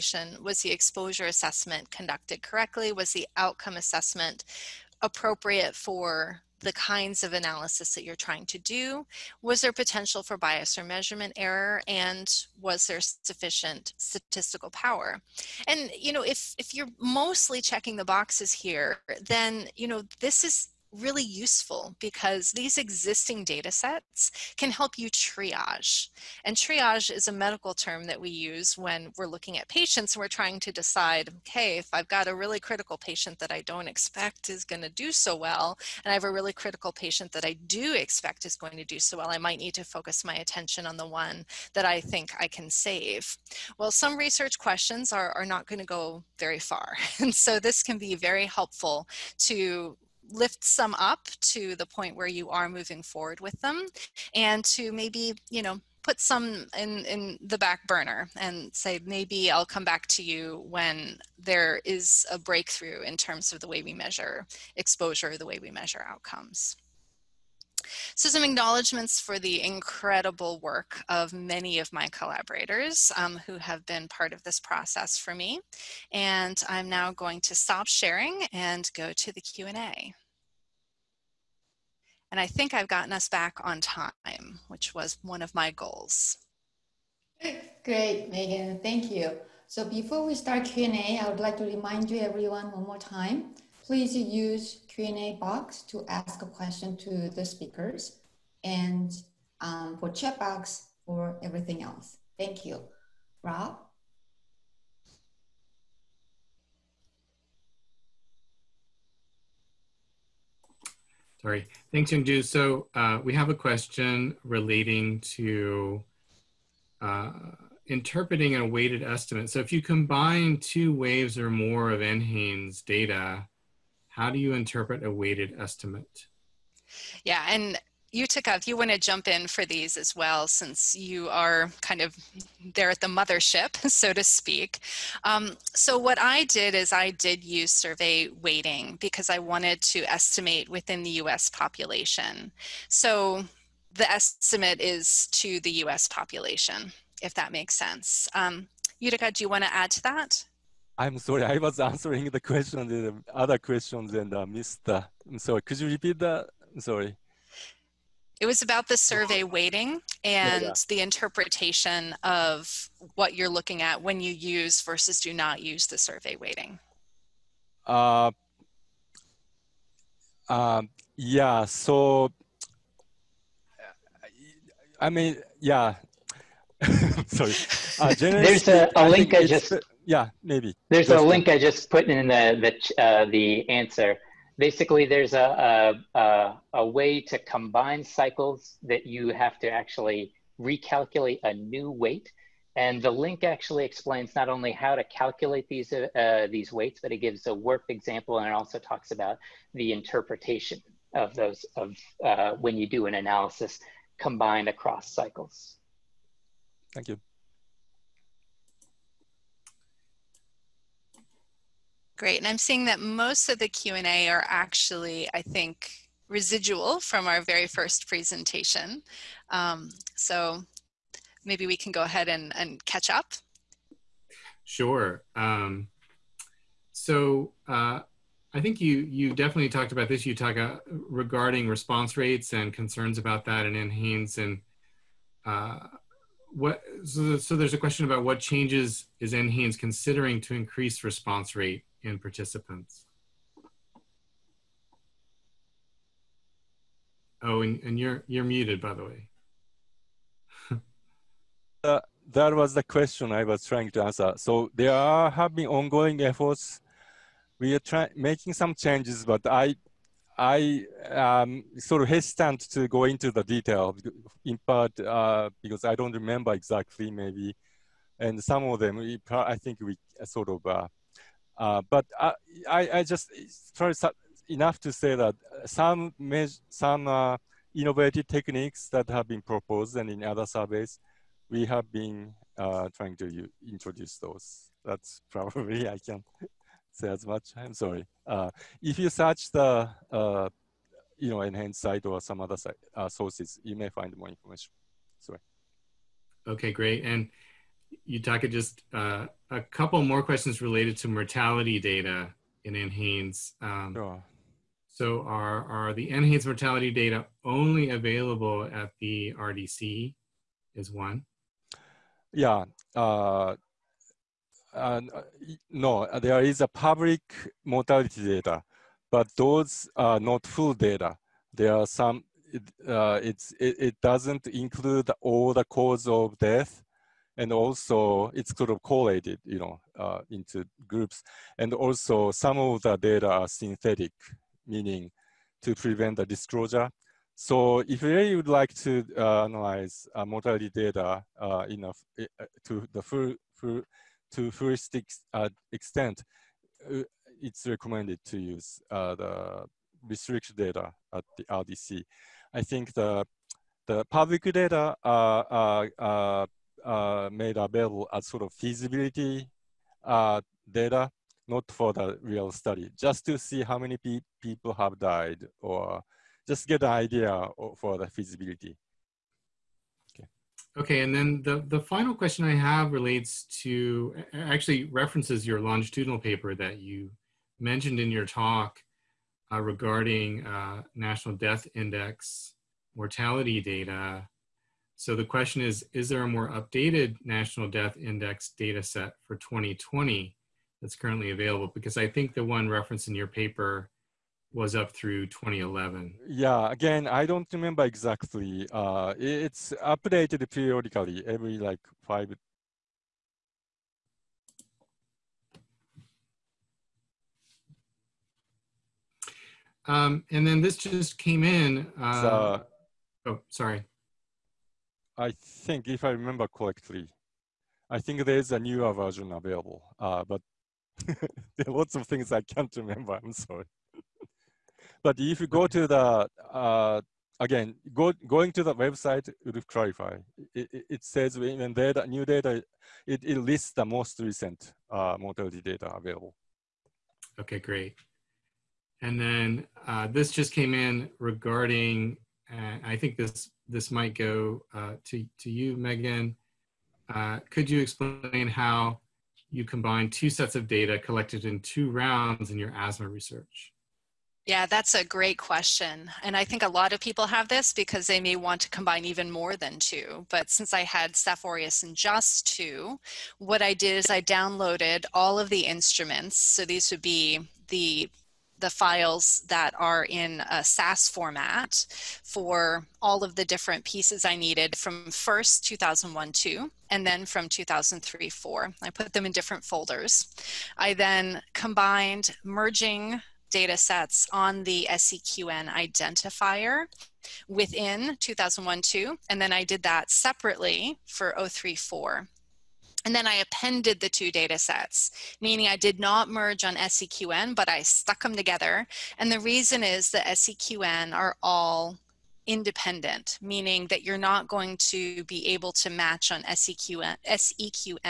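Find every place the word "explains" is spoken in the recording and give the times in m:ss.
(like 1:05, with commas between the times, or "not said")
3:13, 7:27.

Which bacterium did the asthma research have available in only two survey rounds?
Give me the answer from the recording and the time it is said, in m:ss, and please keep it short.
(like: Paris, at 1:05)
Staph aureus, at 7:41.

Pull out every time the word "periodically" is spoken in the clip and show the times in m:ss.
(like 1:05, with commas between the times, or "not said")
6:40.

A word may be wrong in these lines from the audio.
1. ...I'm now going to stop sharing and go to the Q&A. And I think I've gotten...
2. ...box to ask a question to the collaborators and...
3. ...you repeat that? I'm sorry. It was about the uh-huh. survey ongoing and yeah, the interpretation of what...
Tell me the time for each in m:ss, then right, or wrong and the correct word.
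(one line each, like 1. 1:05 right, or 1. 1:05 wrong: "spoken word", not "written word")
1. 1:16 right
2. 1:35 wrong: "speakers", not "collaborators"
3. 2:35 wrong: "weighting", not "ongoing".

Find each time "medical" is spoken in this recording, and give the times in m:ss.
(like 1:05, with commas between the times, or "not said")
0:27.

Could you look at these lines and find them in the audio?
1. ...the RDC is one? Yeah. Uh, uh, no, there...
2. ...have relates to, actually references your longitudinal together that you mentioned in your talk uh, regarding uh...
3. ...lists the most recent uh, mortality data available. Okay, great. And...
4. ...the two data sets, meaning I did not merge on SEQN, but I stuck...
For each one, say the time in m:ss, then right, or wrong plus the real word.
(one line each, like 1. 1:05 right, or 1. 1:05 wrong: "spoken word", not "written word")
1. 5:09 right
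2. 6:12 wrong: "paper", not "together"
3. 7:13 right
4. 8:14 right.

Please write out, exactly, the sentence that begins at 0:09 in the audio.
Was there potential for bias or measurement error?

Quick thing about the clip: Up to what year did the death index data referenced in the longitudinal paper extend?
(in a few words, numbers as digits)
2011.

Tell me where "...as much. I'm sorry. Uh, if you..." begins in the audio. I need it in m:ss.
4:47.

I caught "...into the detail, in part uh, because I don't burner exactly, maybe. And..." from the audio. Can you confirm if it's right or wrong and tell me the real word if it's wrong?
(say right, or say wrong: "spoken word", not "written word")
wrong: "remember", not "burner".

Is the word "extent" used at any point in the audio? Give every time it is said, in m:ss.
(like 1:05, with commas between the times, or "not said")
5:45.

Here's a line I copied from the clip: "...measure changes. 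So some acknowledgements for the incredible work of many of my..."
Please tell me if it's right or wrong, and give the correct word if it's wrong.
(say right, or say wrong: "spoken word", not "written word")
wrong: "outcomes", not "changes".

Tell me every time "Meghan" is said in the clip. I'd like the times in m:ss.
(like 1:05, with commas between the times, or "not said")
1:28, 7:25.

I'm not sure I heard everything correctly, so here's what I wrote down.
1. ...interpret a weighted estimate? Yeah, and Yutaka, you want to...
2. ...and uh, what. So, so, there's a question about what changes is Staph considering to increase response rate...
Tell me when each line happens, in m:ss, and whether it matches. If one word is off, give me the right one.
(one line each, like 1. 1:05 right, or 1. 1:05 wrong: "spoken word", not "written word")
1. 2:04 right
2. 3:54 wrong: "NHANES", not "Staph".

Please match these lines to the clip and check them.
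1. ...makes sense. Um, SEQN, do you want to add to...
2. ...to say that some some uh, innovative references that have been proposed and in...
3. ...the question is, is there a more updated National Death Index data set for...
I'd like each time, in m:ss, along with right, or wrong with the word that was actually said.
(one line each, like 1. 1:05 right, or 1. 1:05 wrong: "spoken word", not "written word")
1. 2:27 wrong: "Yutaka", not "SEQN"
2. 4:34 wrong: "techniques", not "references"
3. 6:25 right.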